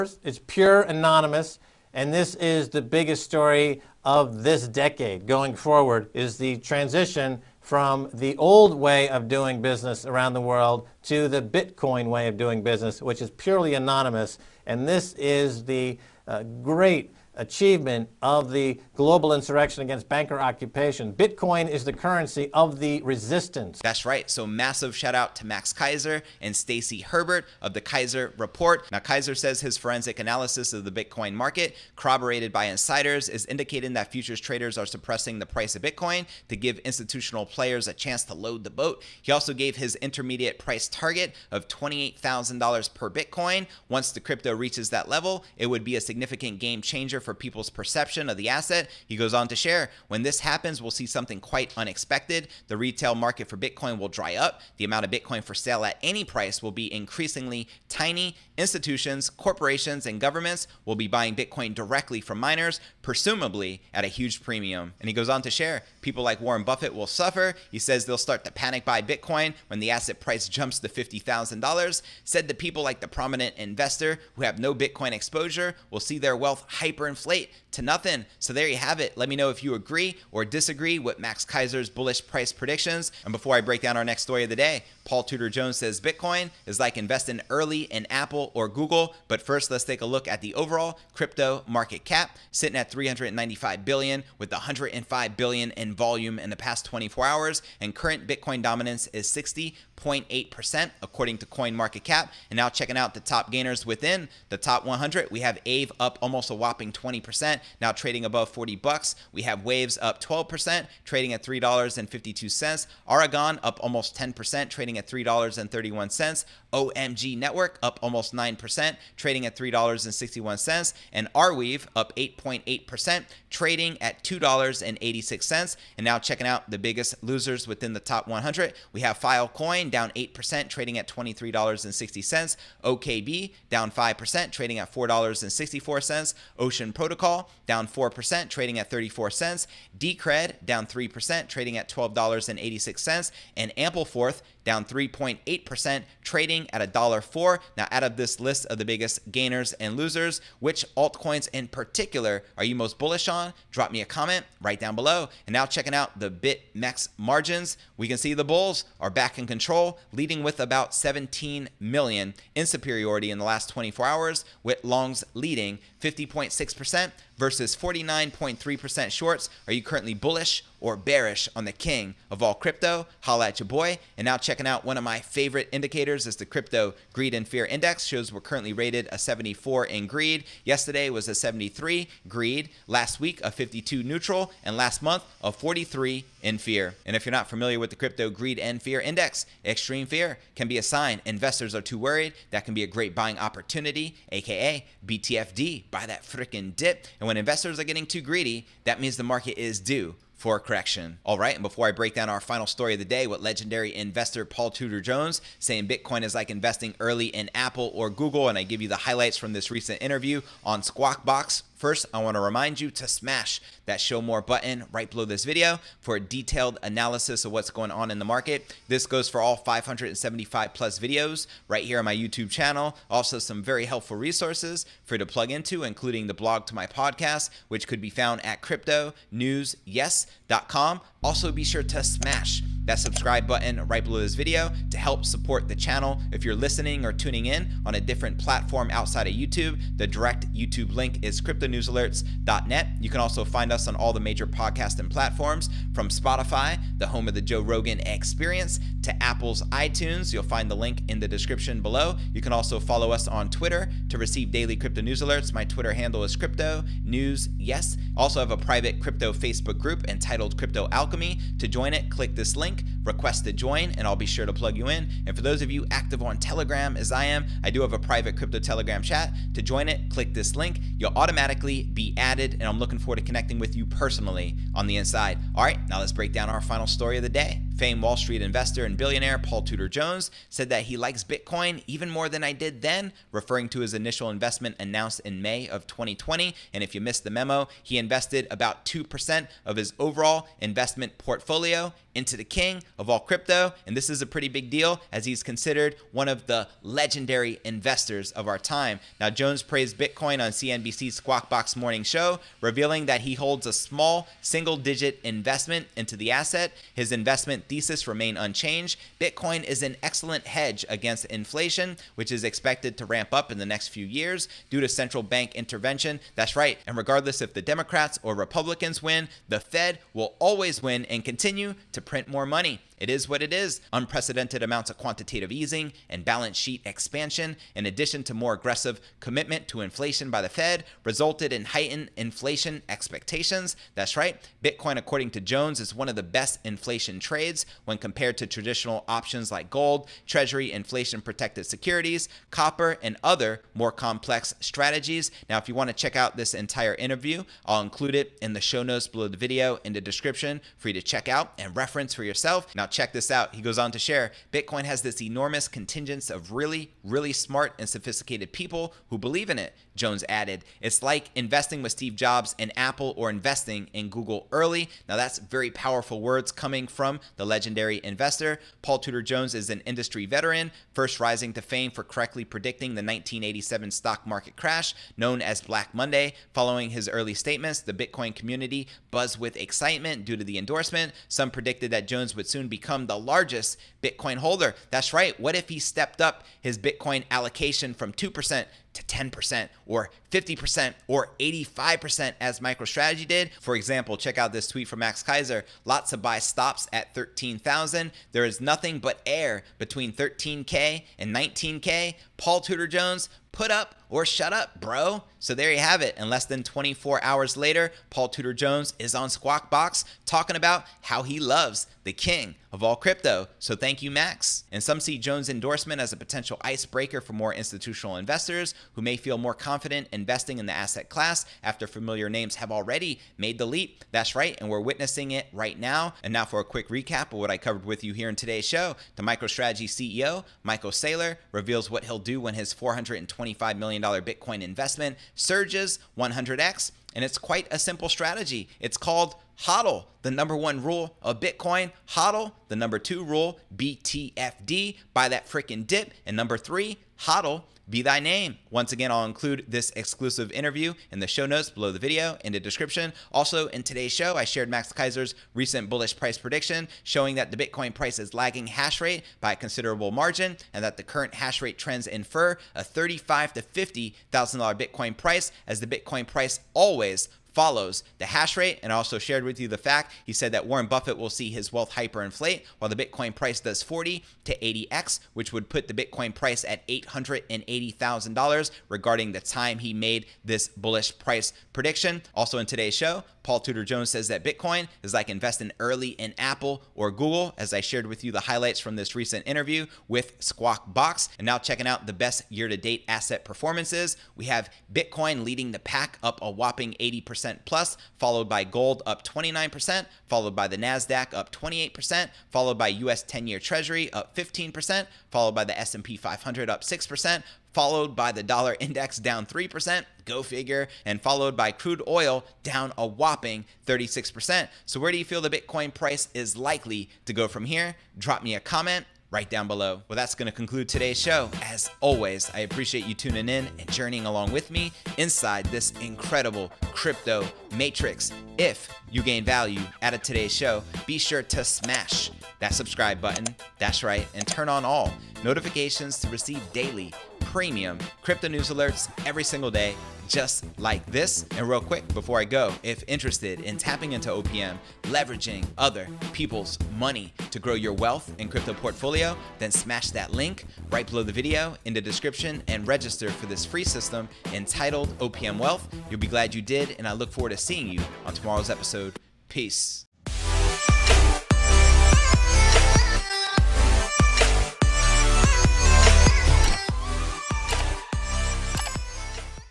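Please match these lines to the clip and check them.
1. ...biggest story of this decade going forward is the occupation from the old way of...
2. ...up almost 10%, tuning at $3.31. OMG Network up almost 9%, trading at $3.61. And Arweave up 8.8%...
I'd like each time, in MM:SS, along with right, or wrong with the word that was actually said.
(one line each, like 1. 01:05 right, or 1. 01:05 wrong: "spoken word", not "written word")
1. 00:02 wrong: "transition", not "occupation"
2. 01:53 wrong: "trading", not "tuning".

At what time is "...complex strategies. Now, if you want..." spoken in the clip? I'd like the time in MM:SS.
05:43.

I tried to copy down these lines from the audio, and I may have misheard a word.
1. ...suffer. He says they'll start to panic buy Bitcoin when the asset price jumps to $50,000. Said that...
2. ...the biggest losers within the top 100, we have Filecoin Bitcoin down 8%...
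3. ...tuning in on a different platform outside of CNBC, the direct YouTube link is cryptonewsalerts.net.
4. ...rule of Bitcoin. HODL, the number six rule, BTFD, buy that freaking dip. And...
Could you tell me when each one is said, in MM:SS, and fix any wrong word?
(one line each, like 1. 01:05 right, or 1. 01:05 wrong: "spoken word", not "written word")
1. 01:07 right
2. 02:06 right
3. 03:57 wrong: "YouTube", not "CNBC"
4. 07:20 wrong: "two", not "six".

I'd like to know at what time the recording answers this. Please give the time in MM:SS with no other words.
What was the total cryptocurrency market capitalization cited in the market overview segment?
01:32.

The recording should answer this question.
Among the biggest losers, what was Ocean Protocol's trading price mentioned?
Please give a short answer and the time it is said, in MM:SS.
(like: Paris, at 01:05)
34 cents, at 02:18.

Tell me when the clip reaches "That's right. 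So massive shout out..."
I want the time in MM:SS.
00:23.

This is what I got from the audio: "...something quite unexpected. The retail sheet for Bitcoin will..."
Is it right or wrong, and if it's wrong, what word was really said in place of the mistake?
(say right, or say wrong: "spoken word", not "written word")
wrong: "market", not "sheet".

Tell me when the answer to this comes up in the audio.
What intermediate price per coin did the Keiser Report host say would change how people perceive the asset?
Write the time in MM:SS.
00:41.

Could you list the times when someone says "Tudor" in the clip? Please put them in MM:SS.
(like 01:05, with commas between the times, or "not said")
01:25, 03:24, 04:39, 06:08, 06:42, 06:48, 08:03.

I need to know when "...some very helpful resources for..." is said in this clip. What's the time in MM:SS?
03:43.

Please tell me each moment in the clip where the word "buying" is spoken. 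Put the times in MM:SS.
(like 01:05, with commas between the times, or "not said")
01:01, 03:13.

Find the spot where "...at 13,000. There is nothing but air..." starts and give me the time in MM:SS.
06:36.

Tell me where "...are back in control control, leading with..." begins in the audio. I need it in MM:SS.
02:38.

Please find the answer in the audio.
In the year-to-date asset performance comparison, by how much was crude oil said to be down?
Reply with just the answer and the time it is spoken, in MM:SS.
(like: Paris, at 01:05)
36%, at 08:33.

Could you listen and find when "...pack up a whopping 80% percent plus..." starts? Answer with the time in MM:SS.
08:15.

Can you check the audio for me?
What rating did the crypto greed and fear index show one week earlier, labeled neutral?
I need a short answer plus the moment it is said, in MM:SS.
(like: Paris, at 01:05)
52, at 03:03.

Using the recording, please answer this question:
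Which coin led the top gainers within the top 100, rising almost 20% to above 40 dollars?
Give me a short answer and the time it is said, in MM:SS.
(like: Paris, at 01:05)
Aave, at 01:45.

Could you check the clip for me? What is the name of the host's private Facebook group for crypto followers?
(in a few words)
Crypto Alchemy.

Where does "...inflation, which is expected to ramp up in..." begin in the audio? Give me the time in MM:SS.
05:11.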